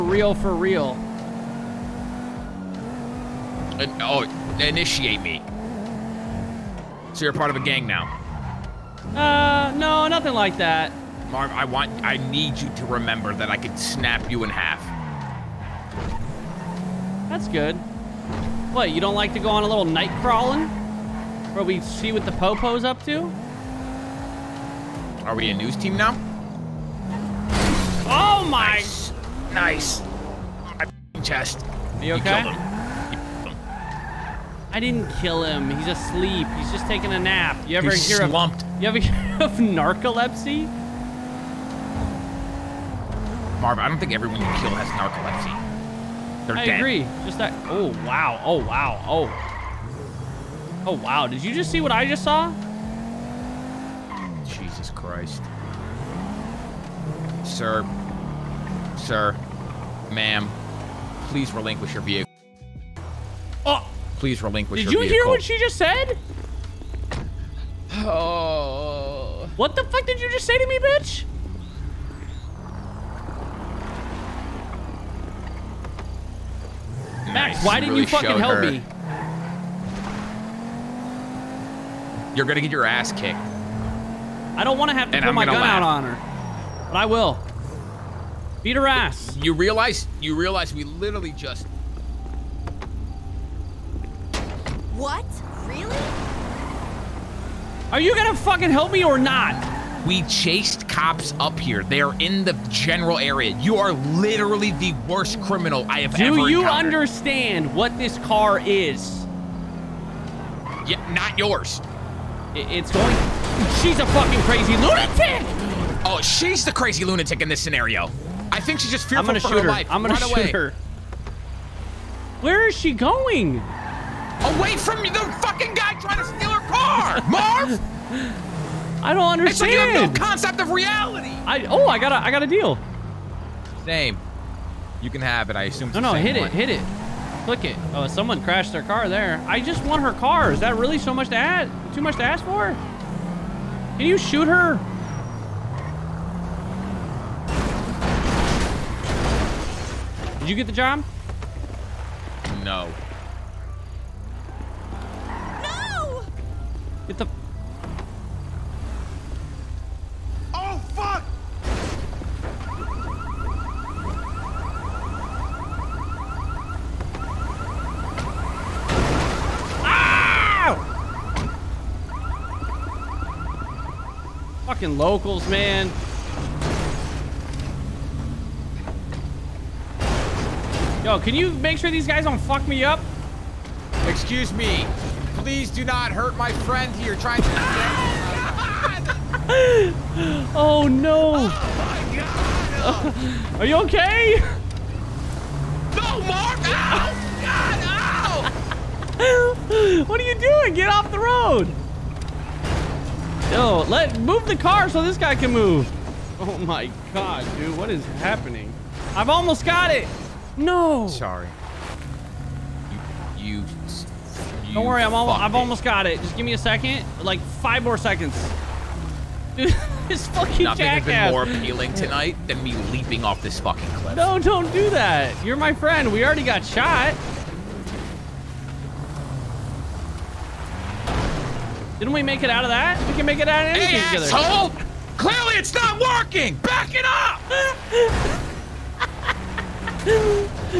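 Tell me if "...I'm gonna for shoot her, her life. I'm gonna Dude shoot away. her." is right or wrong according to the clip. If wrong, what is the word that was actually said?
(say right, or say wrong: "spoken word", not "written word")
wrong: "Run", not "Dude".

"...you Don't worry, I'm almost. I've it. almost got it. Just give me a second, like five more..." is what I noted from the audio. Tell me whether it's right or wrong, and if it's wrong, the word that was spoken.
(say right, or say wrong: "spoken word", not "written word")
right.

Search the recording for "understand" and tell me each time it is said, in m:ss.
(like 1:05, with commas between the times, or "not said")
1:46, 2:09.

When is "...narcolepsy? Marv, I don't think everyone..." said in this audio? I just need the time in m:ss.
0:39.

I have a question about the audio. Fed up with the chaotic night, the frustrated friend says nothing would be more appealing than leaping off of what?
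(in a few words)
cliff.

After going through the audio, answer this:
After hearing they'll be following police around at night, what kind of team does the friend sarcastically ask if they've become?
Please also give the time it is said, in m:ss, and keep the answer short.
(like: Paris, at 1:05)
news team, at 0:25.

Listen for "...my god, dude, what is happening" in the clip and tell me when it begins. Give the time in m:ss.
3:26.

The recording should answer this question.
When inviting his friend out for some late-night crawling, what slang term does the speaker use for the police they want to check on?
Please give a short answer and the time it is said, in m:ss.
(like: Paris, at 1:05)
Popo, at 0:22.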